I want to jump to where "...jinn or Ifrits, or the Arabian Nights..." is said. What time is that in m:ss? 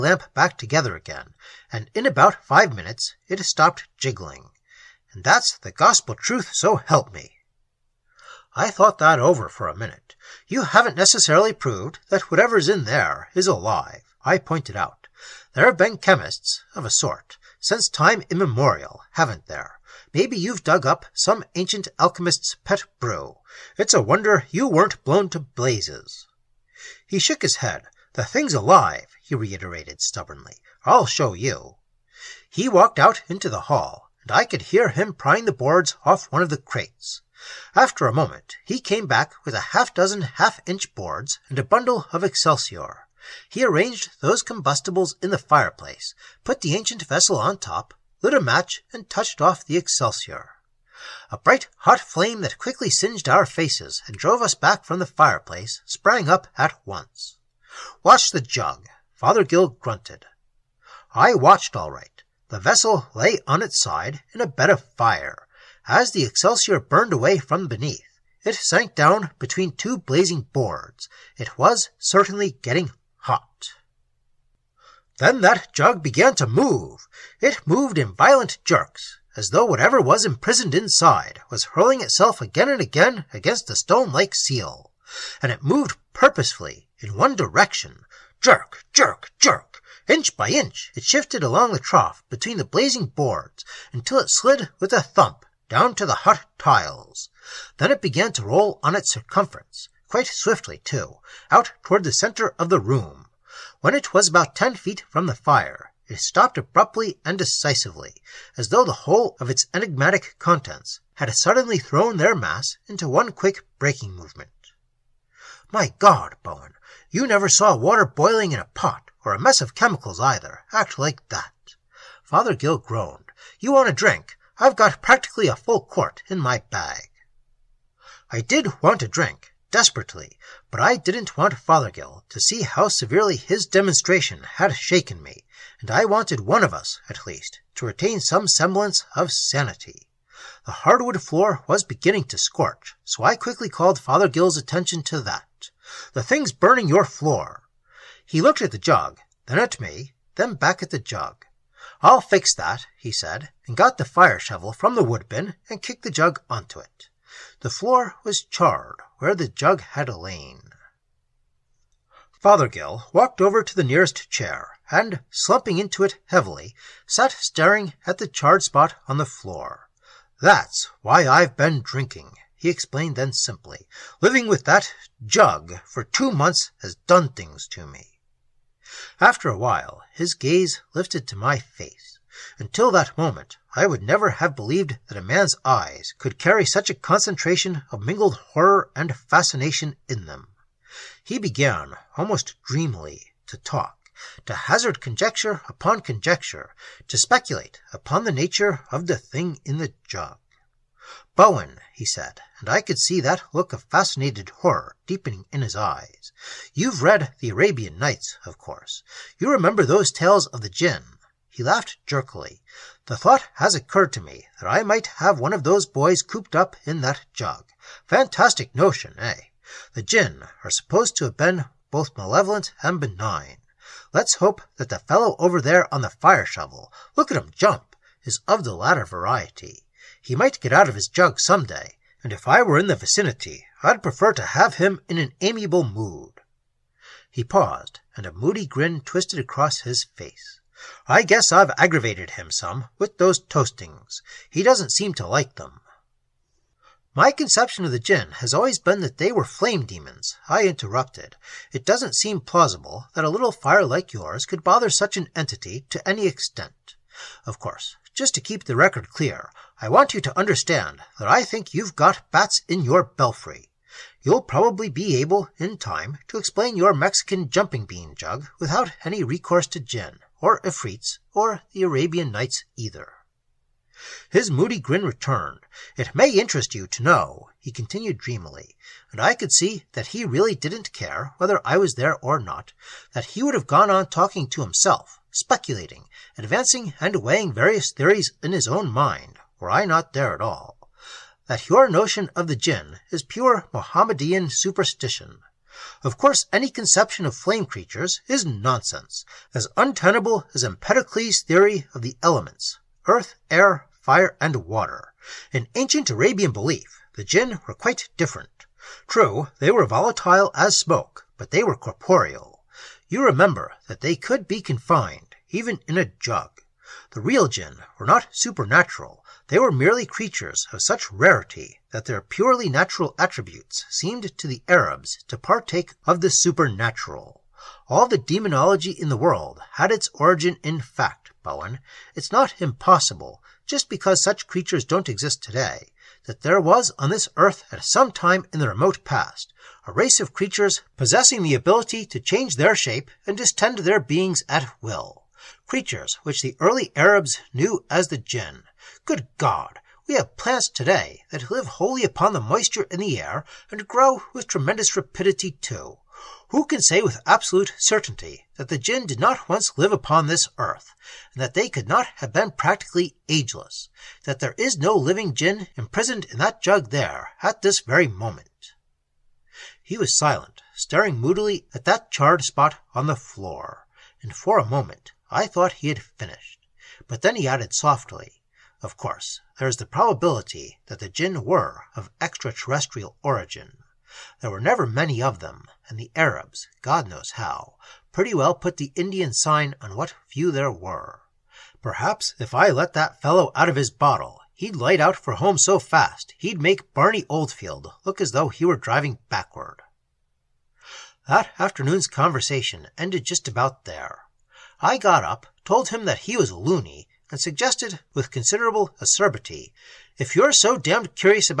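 4:29.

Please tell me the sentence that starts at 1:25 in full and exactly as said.
And it moved purposefully in one direction jerk, jerk, jerk.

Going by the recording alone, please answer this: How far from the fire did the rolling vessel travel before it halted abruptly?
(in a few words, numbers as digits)
10 feet.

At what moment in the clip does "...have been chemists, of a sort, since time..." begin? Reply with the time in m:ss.
0:15.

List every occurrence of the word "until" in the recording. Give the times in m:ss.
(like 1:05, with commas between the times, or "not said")
1:33, 3:02.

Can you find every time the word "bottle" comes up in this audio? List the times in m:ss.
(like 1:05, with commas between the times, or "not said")
6:33.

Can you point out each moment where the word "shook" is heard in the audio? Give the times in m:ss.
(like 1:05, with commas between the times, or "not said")
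0:27.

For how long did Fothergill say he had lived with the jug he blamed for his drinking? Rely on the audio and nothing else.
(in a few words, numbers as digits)
2 months.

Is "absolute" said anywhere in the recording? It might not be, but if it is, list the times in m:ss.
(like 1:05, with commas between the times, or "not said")
5:57.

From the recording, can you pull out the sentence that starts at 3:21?
Bowen, he said, and I could see that look of fascinated horror deepening in his eyes.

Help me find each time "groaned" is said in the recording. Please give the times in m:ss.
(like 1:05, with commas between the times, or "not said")
2:02.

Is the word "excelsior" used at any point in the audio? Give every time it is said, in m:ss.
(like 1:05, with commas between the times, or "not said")
0:42, 0:49, 1:06.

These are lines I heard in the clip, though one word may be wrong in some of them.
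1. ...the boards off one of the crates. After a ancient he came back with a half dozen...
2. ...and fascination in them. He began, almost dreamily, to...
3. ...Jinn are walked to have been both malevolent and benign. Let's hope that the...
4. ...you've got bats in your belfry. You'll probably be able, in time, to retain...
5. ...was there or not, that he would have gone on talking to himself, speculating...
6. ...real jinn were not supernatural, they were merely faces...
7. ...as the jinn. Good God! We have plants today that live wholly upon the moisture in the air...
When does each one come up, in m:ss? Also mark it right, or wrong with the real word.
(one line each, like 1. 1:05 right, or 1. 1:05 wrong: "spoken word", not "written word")
1. 0:35 wrong: "moment", not "ancient"
2. 3:08 right
3. 3:40 wrong: "supposed", not "walked"
4. 4:21 wrong: "explain", not "retain"
5. 4:41 right
6. 5:17 wrong: "creatures", not "faces"
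7. 5:47 right.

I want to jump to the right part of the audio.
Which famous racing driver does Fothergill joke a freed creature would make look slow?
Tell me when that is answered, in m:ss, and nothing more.
6:36.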